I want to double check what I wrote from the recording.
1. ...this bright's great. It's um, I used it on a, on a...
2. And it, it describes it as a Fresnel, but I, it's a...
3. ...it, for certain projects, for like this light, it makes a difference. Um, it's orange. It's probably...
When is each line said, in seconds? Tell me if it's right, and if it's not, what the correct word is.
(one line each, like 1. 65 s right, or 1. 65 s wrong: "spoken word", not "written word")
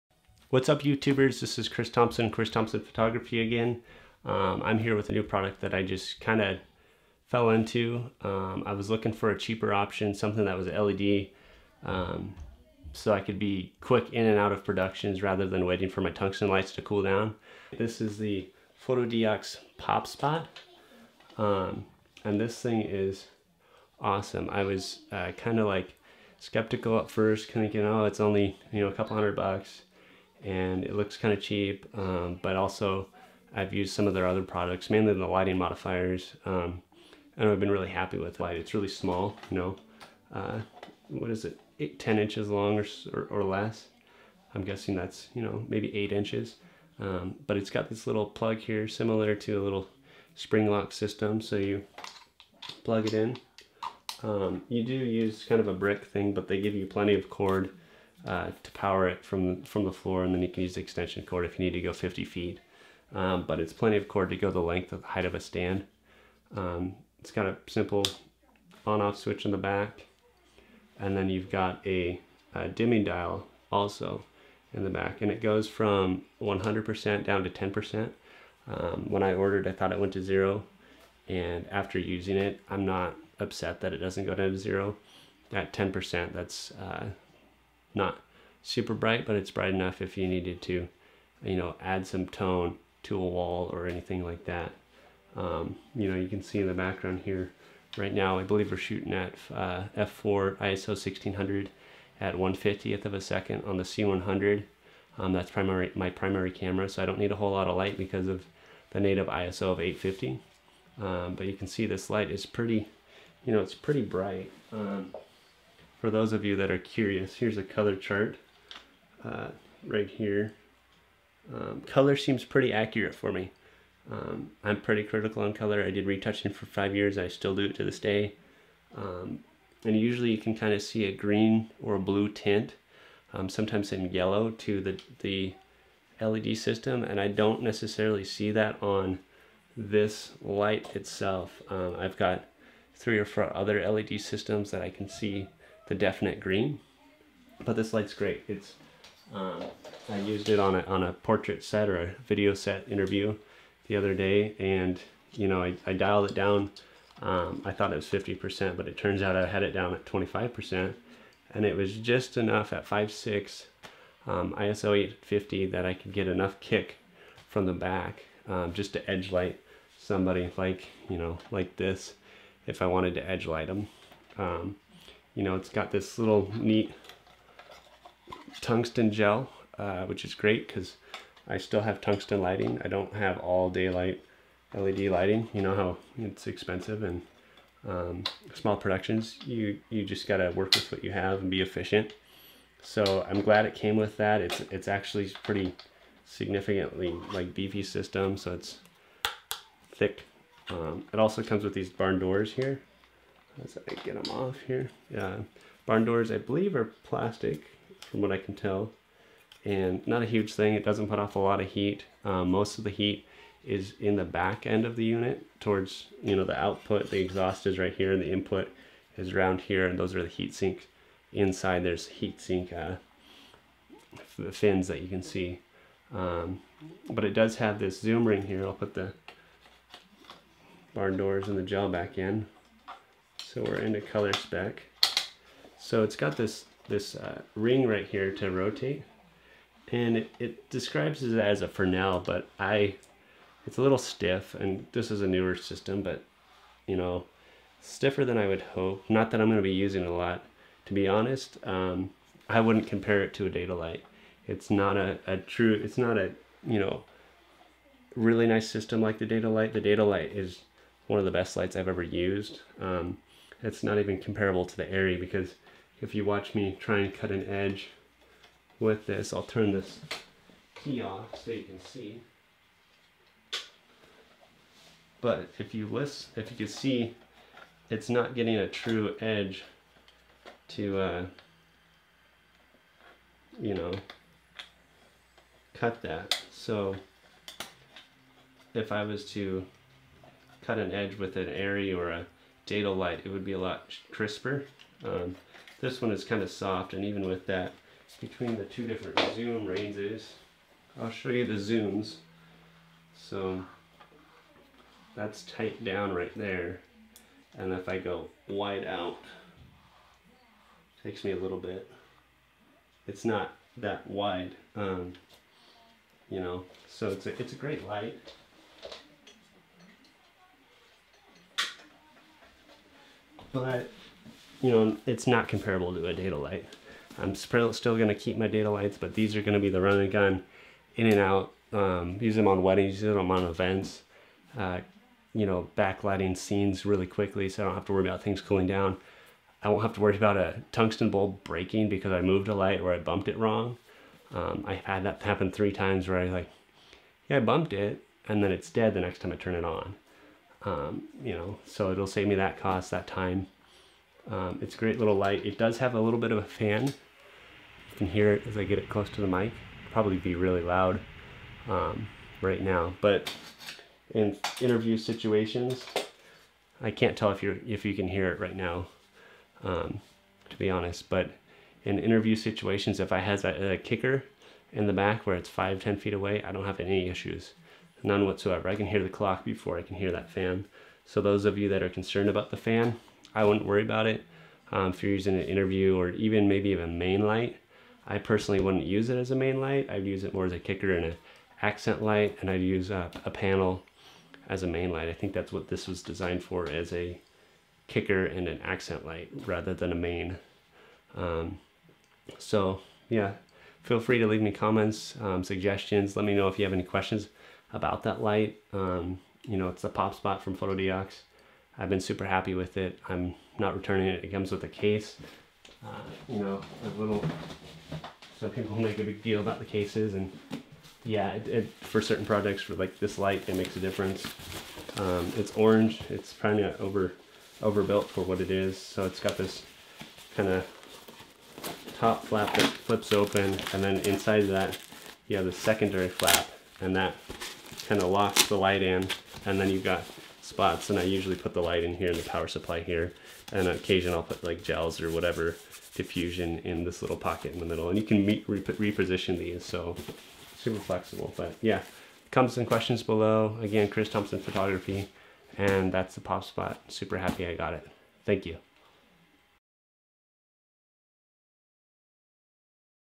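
1. 147 s wrong: "light", not "bright"
2. 239 s right
3. 421 s right.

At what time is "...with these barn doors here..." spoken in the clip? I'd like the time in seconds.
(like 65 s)
201 s.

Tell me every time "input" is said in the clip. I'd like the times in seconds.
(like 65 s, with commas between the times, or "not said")
218 s.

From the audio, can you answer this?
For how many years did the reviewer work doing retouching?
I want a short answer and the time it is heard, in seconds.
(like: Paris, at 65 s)
5, at 126 s.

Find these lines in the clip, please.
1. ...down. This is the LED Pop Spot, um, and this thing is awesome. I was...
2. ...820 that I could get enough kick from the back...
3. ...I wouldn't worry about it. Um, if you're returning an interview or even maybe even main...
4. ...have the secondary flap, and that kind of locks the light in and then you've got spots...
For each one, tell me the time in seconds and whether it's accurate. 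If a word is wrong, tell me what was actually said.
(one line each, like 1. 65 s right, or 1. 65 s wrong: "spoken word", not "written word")
1. 17 s wrong: "Fotodiox", not "LED"
2. 164 s wrong: "850", not "820"
3. 383 s wrong: "using", not "returning"
4. 435 s right.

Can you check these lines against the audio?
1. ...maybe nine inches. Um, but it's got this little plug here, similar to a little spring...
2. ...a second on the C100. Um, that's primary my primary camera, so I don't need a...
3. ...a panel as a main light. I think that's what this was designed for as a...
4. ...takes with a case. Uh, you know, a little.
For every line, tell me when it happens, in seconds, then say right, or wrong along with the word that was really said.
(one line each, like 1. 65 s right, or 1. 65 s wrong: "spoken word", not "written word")
1. 45 s wrong: "eight", not "nine"
2. 103 s right
3. 393 s right
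4. 414 s wrong: "comes", not "takes".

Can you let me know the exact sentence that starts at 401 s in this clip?
Um, so yeah, feel free to leave me comments, um, suggestions.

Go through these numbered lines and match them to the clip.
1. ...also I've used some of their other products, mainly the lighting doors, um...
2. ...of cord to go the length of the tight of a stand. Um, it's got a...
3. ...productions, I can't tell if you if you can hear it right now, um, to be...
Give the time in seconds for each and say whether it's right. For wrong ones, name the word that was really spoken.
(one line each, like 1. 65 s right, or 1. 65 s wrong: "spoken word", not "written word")
1. 32 s wrong: "modifiers", not "doors"
2. 63 s wrong: "height", not "tight"
3. 364 s wrong: "situations", not "productions".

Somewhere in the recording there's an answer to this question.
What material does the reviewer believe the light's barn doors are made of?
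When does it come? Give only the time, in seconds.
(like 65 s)
207 s.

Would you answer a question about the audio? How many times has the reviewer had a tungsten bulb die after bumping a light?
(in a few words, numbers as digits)
3.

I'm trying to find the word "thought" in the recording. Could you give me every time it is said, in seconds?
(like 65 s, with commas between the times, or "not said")
79 s, 157 s.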